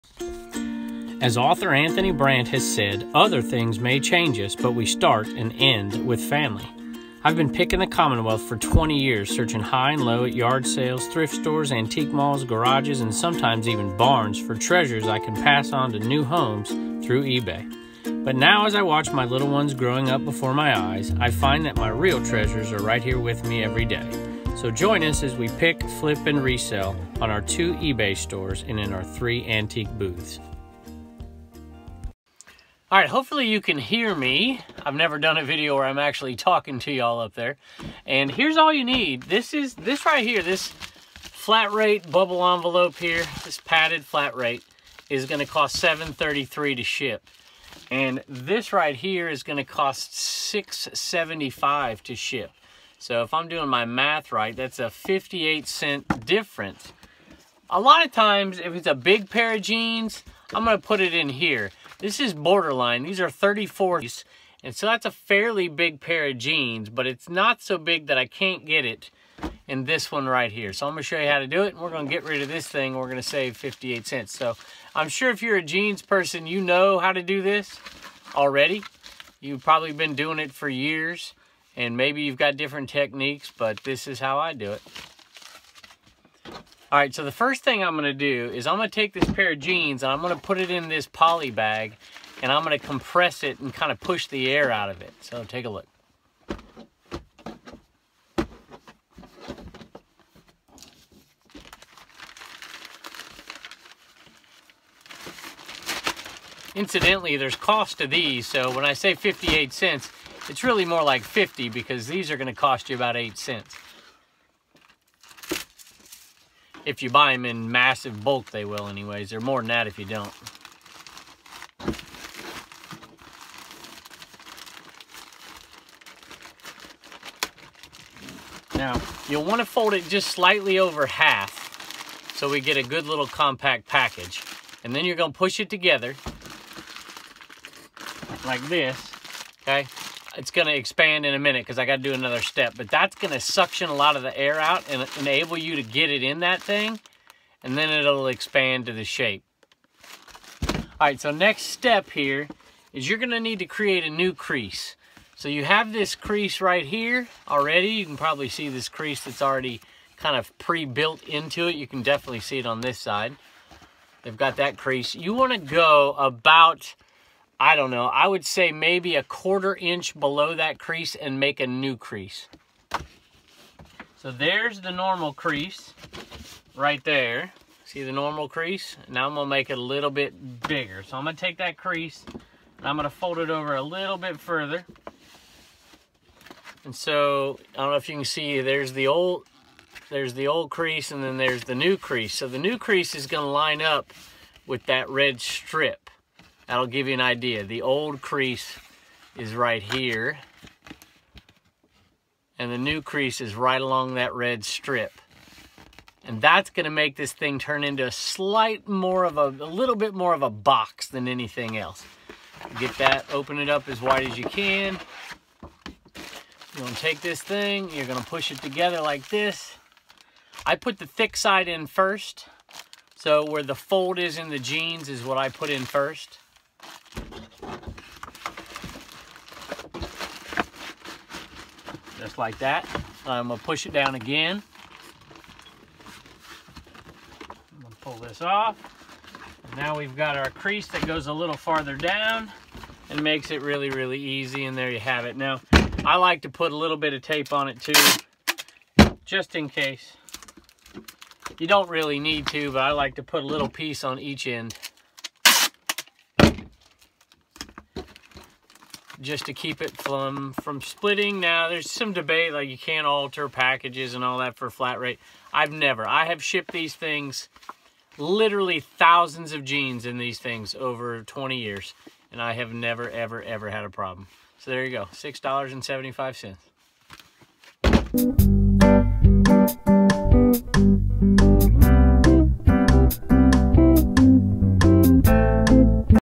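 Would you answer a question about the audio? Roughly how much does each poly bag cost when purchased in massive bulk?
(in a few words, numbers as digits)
8 cents.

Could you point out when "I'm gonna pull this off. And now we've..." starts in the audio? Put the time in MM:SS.
03:57.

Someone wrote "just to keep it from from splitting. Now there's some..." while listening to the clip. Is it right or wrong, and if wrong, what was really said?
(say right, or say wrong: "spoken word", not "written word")
right.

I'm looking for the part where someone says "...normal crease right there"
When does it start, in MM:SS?
02:54.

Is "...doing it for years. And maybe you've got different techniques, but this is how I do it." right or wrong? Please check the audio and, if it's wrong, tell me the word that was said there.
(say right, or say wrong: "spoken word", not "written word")
right.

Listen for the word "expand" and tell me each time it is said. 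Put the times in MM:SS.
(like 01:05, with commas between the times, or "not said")
02:20, 02:28.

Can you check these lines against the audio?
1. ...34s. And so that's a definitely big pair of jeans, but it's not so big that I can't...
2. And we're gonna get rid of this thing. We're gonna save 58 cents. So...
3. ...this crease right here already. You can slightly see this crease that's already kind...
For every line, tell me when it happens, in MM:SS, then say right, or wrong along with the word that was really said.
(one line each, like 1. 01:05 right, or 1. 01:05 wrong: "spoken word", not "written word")
1. 01:03 wrong: "fairly", not "definitely"
2. 01:11 right
3. 02:35 wrong: "probably", not "slightly".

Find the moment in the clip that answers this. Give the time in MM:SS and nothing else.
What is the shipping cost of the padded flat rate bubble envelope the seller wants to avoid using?
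00:45.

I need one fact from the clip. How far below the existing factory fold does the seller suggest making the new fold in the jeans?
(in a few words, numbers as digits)
a quarter inch.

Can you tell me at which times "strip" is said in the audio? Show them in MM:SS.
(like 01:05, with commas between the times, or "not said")
03:15, 03:24.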